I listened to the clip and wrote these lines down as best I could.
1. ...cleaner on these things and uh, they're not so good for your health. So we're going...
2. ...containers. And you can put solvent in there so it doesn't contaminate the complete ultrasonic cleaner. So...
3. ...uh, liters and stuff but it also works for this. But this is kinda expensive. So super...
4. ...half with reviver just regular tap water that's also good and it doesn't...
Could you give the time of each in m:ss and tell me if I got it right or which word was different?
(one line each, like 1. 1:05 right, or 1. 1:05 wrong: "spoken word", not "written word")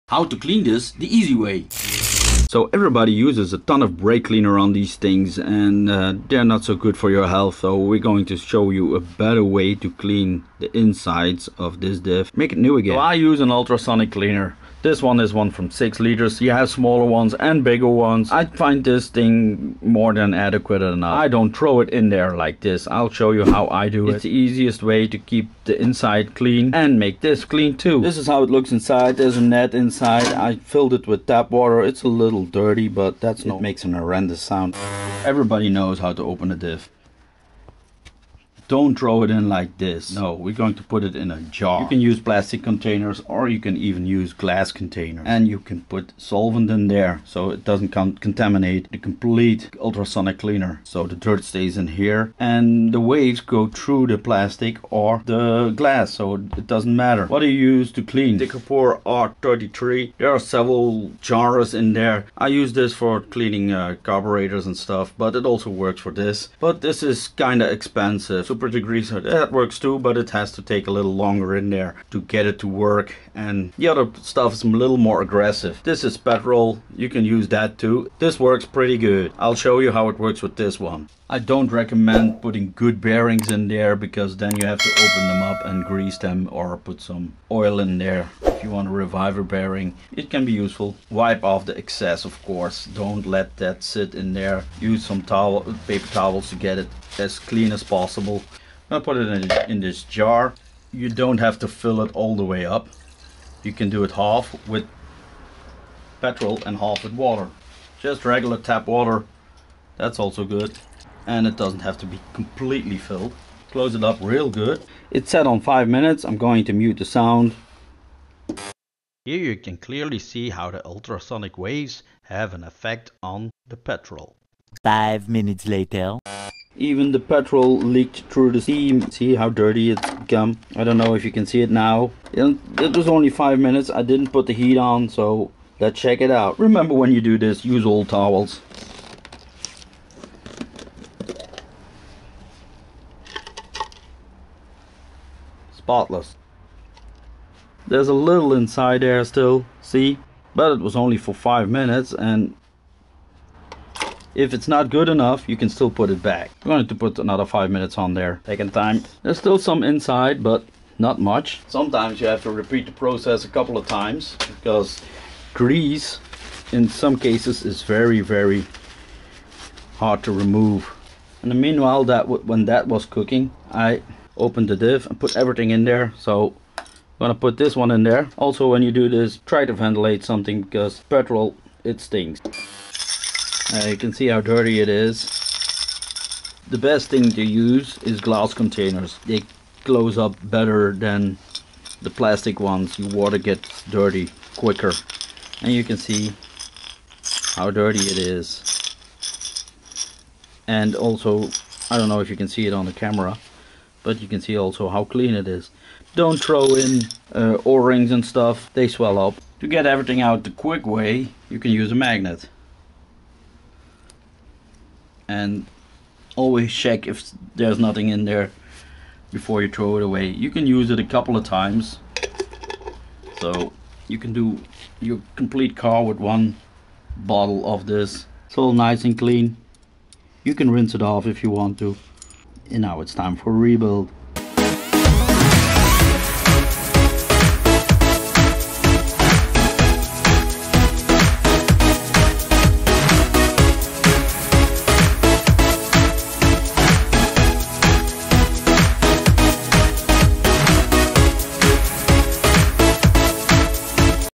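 1. 0:04 right
2. 0:44 right
3. 1:03 wrong: "carburetors", not "liters"
4. 1:46 wrong: "water", not "reviver".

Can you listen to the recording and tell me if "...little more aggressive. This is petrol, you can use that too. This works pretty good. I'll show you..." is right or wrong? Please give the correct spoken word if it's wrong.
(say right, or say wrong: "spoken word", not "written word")
right.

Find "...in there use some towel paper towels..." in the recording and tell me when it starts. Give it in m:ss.
1:34.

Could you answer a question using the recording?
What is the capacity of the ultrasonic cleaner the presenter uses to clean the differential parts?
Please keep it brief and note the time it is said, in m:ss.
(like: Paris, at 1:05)
6 liters, at 0:15.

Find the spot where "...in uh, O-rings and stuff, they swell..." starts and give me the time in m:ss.
3:26.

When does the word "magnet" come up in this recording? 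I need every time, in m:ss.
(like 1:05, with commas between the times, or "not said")
3:31.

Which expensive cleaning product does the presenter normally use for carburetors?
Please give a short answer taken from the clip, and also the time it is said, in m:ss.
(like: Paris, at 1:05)
Decapore R33, at 0:58.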